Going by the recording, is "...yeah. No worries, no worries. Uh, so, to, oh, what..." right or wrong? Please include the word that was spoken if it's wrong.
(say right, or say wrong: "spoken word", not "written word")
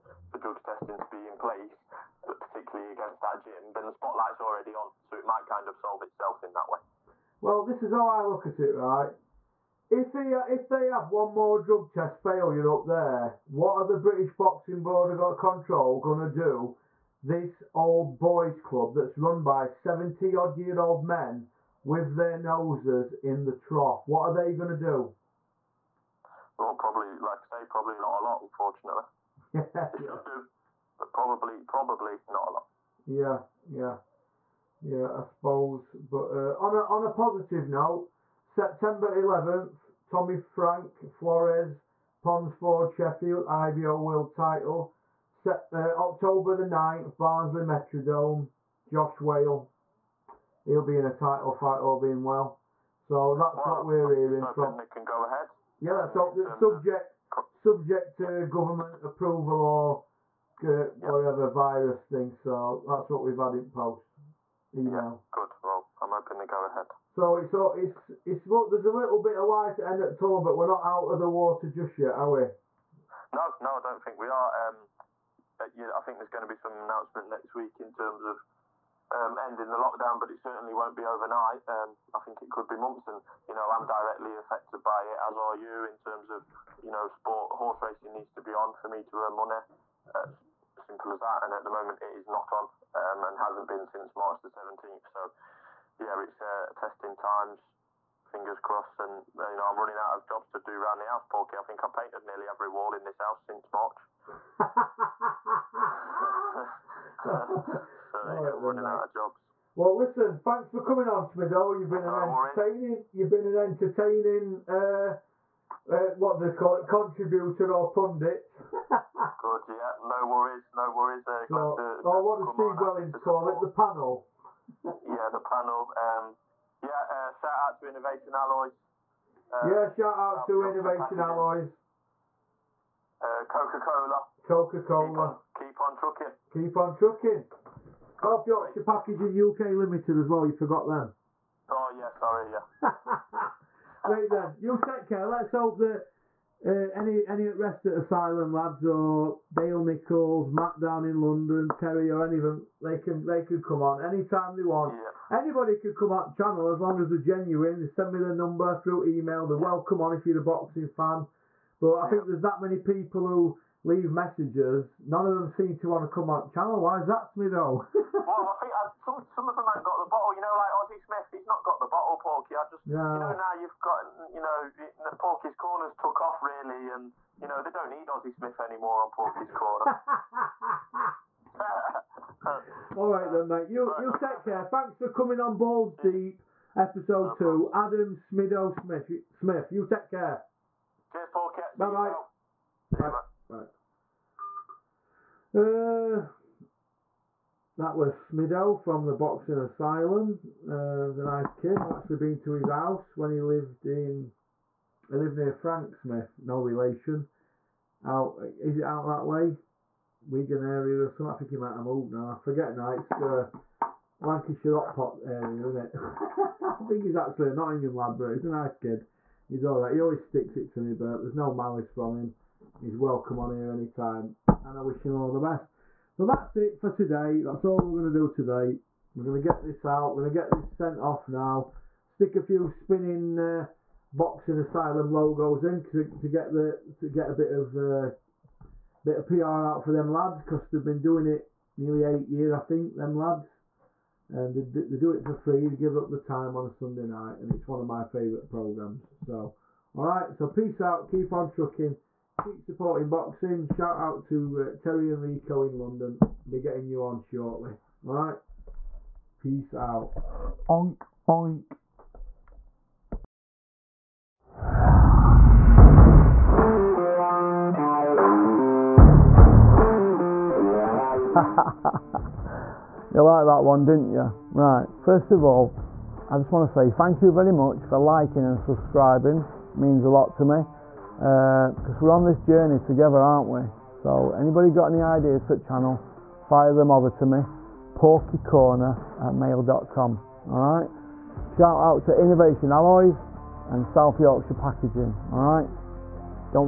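right.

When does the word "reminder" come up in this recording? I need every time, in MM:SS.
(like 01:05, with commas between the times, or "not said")
not said.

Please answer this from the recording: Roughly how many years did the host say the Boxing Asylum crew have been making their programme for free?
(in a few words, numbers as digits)
8 years.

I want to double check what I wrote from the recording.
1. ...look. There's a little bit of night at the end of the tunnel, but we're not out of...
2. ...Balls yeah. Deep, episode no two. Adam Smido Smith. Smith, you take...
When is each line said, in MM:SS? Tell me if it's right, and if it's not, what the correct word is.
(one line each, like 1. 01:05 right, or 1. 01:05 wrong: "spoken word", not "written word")
1. 01:08 wrong: "light", not "night"
2. 03:05 right.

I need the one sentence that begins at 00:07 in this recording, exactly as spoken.
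Well, this is how I look at it, right?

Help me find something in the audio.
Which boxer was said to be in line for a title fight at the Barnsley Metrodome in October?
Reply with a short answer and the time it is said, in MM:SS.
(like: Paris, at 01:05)
Josh Wale, at 00:48.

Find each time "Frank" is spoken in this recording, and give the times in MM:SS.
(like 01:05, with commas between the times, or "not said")
00:40, 03:25.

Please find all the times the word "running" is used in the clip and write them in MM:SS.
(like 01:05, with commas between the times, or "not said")
01:39, 01:48.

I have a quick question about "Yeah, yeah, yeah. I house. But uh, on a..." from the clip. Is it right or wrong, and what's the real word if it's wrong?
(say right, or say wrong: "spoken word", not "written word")
wrong: "suppose", not "house".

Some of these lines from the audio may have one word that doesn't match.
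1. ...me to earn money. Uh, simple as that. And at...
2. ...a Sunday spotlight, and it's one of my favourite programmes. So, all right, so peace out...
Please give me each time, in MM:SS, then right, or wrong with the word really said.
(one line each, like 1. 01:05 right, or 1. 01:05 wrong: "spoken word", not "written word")
1. 01:28 right
2. 04:06 wrong: "night", not "spotlight".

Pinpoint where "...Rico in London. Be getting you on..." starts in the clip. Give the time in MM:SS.
04:15.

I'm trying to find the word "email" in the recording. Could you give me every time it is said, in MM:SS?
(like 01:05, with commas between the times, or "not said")
01:04, 02:39.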